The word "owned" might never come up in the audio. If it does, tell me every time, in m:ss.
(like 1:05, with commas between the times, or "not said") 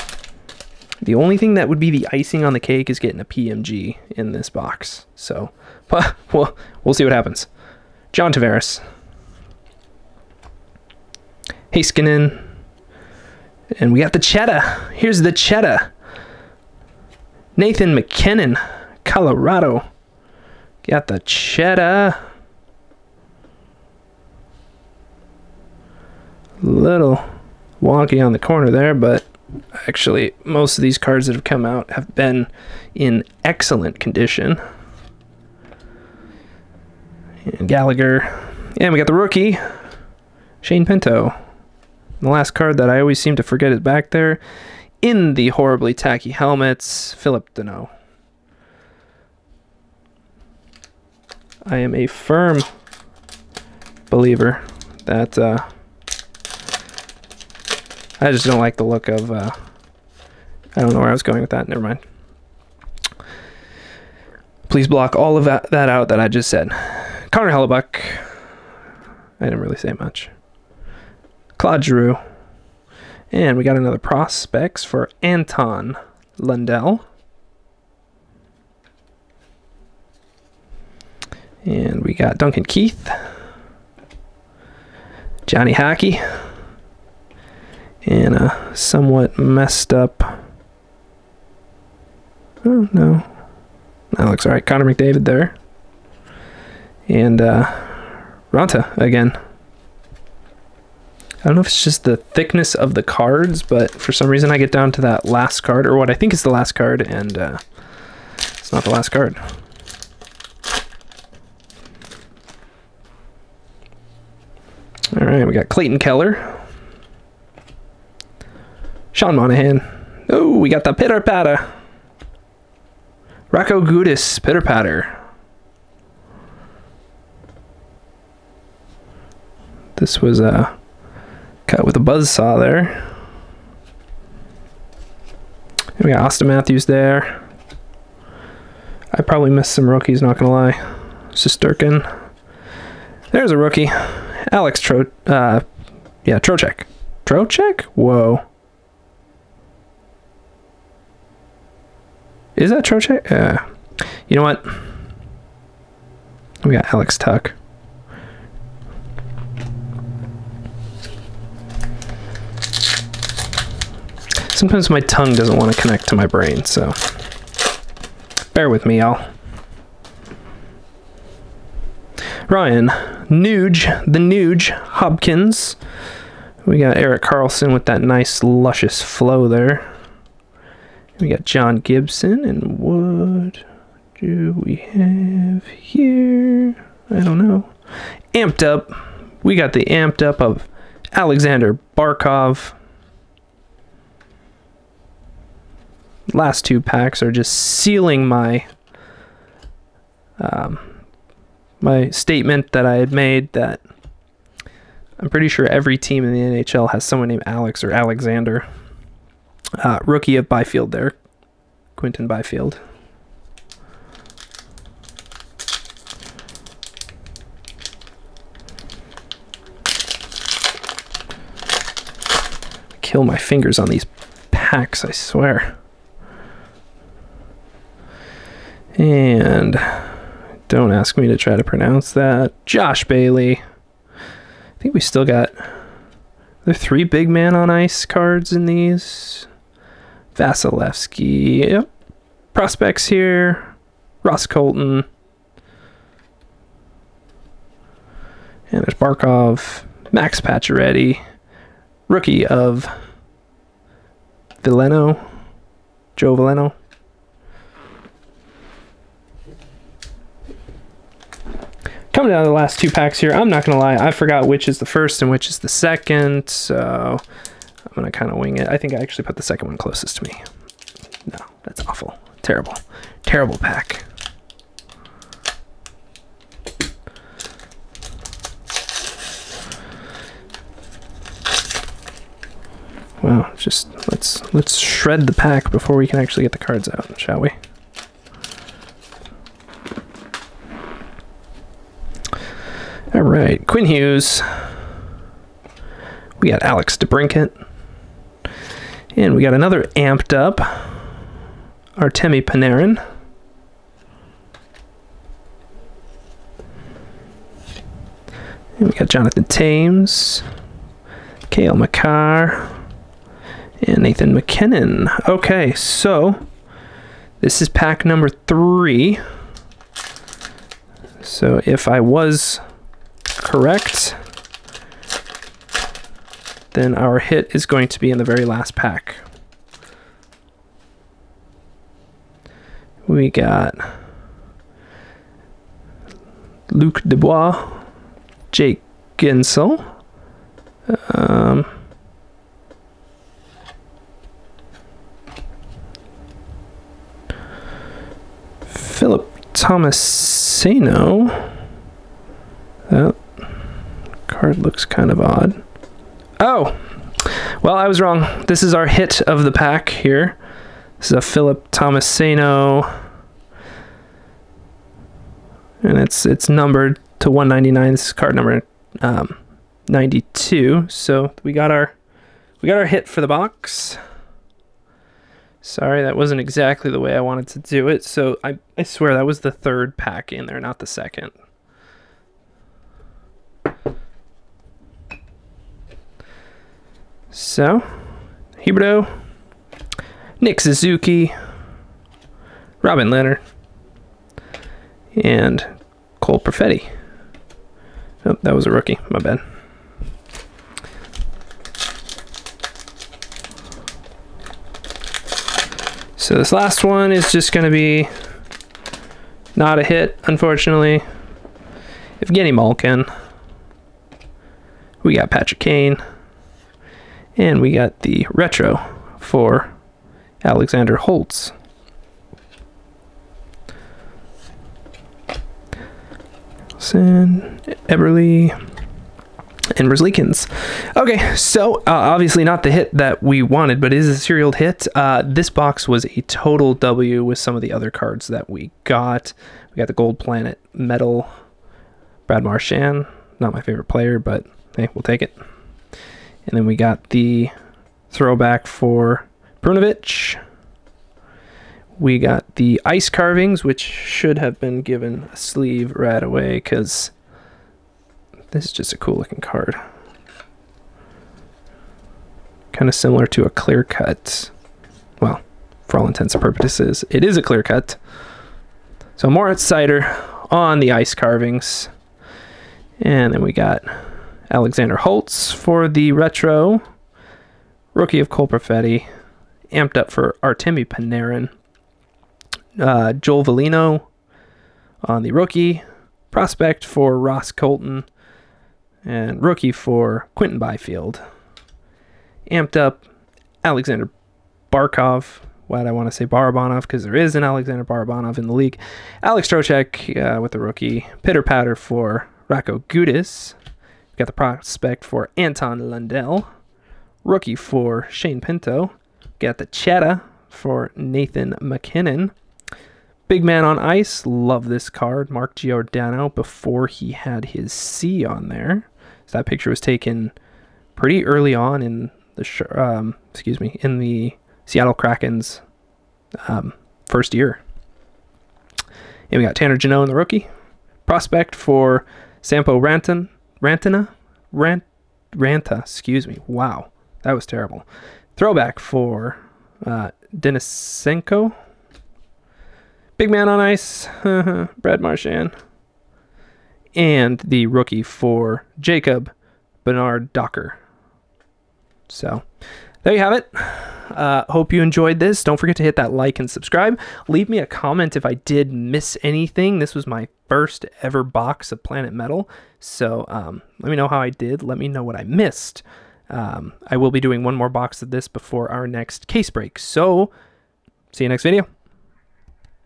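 not said.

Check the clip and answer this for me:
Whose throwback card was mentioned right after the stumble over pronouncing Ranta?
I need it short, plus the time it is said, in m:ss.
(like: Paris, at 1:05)
Denisenko, at 9:00.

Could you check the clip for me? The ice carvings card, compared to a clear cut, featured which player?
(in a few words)
Seider.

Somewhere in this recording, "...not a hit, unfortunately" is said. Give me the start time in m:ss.
6:49.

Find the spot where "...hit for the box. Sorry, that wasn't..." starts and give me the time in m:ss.
6:12.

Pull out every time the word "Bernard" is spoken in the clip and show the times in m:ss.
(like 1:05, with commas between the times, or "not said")
9:09.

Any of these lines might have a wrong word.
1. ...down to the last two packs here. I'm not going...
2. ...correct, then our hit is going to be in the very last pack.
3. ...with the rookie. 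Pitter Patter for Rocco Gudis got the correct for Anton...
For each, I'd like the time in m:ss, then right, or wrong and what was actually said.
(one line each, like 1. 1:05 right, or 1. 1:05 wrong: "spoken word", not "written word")
1. 4:22 right
2. 5:23 right
3. 8:20 wrong: "prospect", not "correct".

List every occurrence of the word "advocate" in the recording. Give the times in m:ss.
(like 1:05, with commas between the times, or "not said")
not said.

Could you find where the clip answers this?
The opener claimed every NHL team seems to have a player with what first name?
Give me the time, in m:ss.
3:27.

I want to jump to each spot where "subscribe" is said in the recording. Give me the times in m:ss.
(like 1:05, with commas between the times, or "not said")
9:16.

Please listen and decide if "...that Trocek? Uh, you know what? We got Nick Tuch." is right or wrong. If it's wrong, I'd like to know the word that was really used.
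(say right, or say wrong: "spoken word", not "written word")
wrong: "Alex", not "Nick".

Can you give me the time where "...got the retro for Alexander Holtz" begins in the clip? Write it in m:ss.
6:57.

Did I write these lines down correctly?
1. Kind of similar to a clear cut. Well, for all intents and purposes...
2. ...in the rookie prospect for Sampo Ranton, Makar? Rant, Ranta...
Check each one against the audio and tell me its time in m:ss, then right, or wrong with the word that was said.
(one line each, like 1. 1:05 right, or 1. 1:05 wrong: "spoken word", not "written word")
1. 7:42 right
2. 8:50 wrong: "Rantina", not "Makar".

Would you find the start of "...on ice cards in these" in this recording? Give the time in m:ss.
3:57.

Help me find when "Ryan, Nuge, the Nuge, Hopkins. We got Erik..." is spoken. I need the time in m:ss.
2:52.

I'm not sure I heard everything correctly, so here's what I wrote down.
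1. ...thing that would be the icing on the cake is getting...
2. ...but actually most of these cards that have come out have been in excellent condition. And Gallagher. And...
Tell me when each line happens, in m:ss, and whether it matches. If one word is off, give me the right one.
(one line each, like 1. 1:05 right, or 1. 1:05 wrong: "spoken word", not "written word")
1. 0:01 right
2. 0:28 right.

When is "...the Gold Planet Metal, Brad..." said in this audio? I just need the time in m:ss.
7:19.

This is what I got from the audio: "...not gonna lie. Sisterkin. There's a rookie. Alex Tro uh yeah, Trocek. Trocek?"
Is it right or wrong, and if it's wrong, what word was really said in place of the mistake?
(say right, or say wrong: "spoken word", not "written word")
right.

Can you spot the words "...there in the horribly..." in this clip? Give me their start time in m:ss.
0:44.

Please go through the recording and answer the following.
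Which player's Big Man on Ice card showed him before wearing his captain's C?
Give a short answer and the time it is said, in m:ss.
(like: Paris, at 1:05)
Mark Giordano, at 8:35.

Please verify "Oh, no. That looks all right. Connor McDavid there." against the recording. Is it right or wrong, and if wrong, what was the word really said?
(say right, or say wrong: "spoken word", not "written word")
right.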